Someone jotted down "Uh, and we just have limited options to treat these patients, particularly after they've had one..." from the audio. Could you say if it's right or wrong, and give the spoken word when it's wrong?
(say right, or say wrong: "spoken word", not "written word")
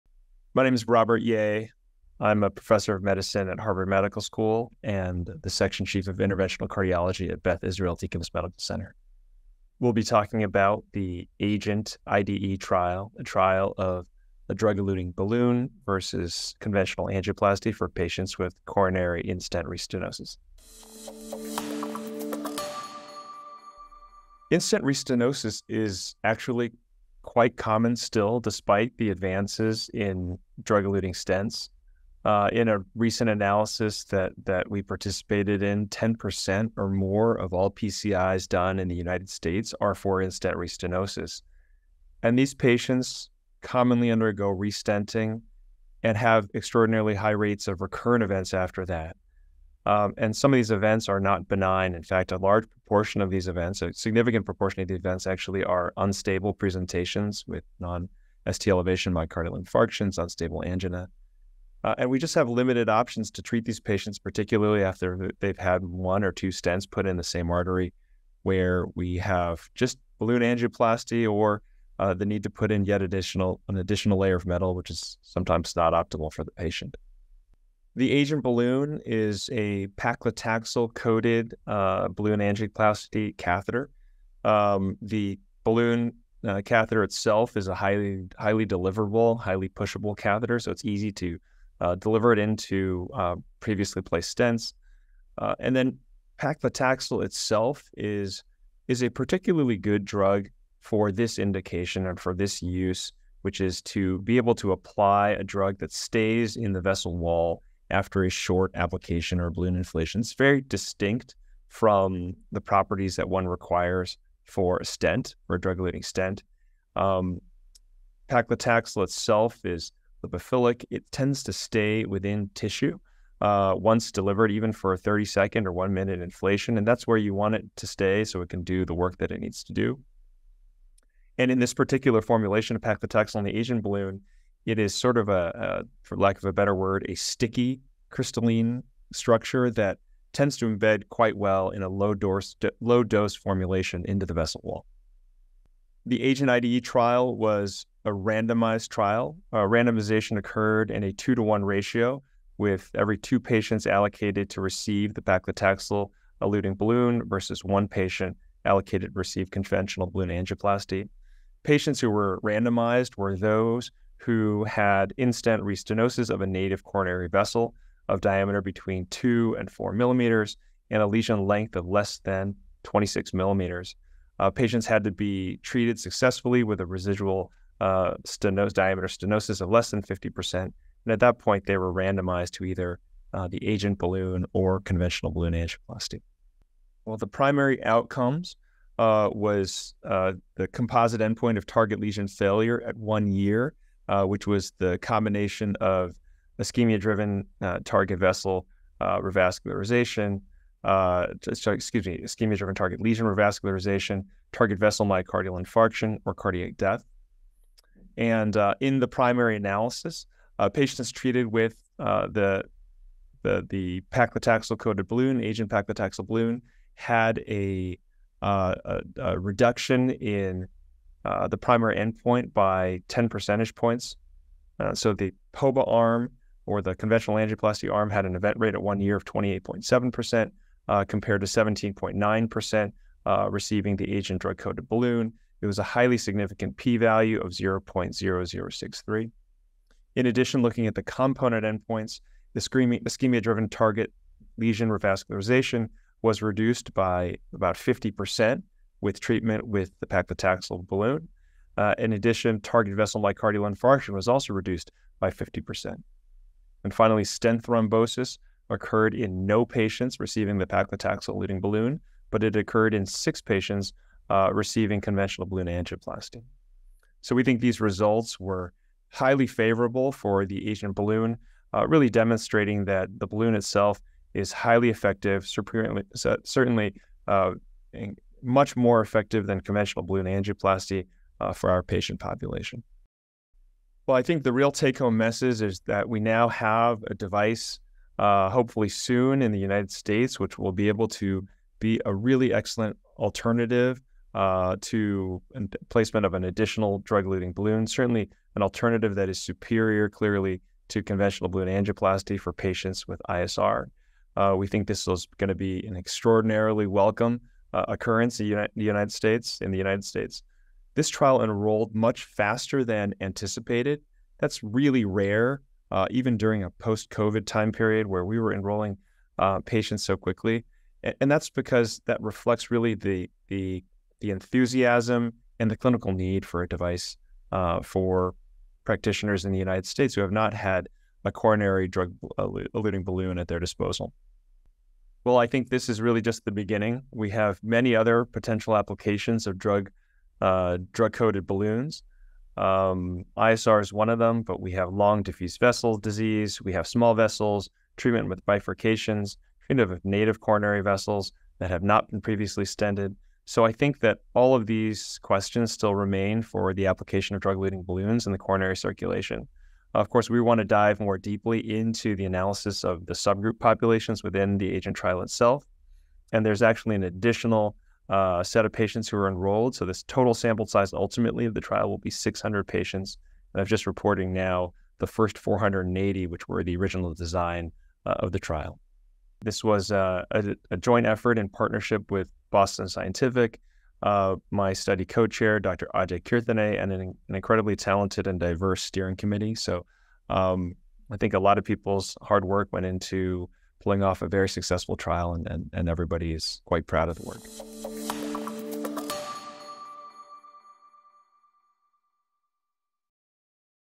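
right.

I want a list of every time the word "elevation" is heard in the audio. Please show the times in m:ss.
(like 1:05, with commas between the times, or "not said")
0:58.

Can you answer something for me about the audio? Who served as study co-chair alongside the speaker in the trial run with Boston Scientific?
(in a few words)
Ajay Kirtane.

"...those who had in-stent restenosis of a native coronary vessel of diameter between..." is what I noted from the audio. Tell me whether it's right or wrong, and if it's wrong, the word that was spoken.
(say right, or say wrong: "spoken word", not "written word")
right.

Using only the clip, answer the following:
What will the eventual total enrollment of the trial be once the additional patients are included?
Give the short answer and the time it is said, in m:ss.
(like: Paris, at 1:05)
600, at 6:12.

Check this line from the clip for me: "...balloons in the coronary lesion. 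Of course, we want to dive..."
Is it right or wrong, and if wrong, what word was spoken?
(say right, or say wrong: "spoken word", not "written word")
wrong: "circulation", not "lesion".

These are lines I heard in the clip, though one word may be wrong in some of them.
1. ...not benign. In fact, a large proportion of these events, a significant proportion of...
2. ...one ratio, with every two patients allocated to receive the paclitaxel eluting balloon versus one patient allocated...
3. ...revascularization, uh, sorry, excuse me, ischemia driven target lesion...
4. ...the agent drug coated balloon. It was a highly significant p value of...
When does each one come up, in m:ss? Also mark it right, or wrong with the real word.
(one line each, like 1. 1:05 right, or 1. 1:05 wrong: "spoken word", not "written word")
1. 0:51 right
2. 2:31 right
3. 3:19 right
4. 3:53 right.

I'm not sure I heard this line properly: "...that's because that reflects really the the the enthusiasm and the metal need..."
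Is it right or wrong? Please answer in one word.
wrong.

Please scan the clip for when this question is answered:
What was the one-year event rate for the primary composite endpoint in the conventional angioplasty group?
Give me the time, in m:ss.
3:49.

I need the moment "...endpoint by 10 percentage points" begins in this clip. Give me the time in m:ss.
3:41.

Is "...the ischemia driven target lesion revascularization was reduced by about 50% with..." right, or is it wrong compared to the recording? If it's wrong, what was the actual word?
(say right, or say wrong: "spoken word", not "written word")
right.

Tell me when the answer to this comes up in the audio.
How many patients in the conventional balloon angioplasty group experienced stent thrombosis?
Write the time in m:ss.
4:23.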